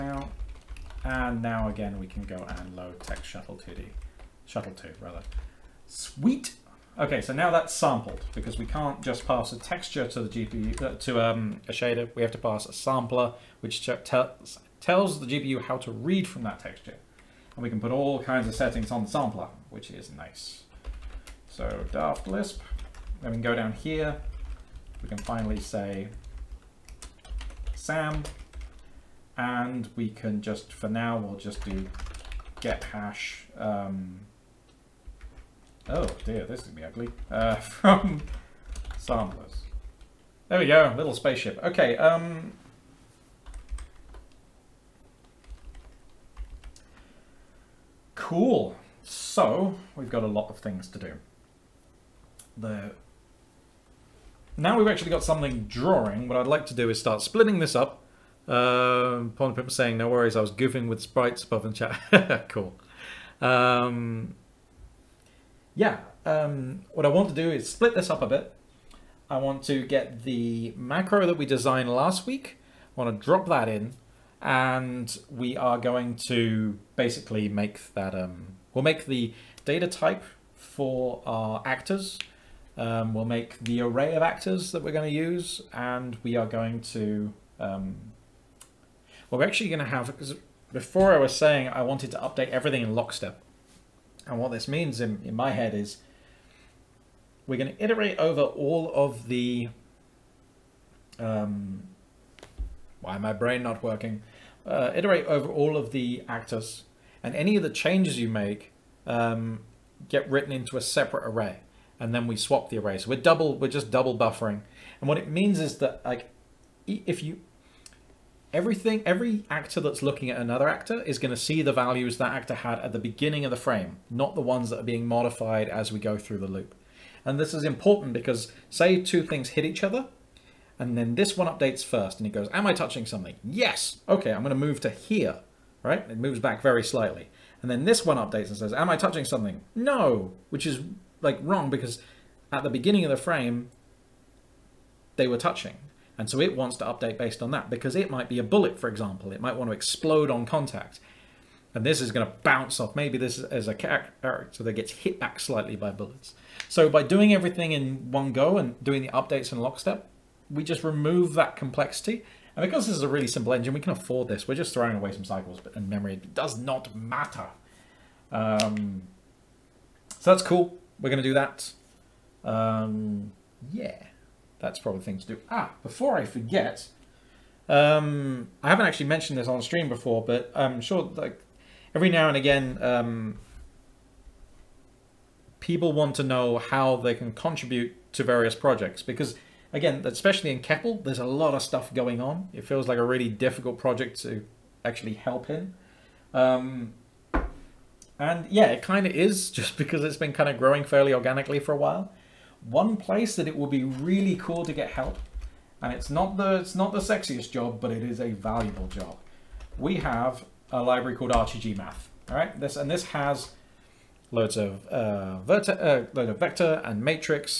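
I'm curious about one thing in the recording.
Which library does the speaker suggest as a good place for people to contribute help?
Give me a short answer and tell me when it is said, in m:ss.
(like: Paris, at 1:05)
Math, at 3:31.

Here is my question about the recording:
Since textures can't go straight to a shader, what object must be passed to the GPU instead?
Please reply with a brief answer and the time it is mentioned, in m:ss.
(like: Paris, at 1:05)
A sampler, at 0:12.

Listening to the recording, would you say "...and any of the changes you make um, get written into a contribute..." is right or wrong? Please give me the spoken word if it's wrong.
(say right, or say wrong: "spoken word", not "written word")
wrong: "separate", not "contribute".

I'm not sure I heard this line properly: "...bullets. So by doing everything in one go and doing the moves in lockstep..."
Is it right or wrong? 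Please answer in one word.
wrong.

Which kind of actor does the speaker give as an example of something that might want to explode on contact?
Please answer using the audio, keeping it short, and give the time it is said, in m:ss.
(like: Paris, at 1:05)
A bullet, at 2:28.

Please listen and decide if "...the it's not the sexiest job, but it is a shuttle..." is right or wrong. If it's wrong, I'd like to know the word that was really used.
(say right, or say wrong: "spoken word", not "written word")
wrong: "valuable", not "shuttle".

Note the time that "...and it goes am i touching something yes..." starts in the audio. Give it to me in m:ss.
2:12.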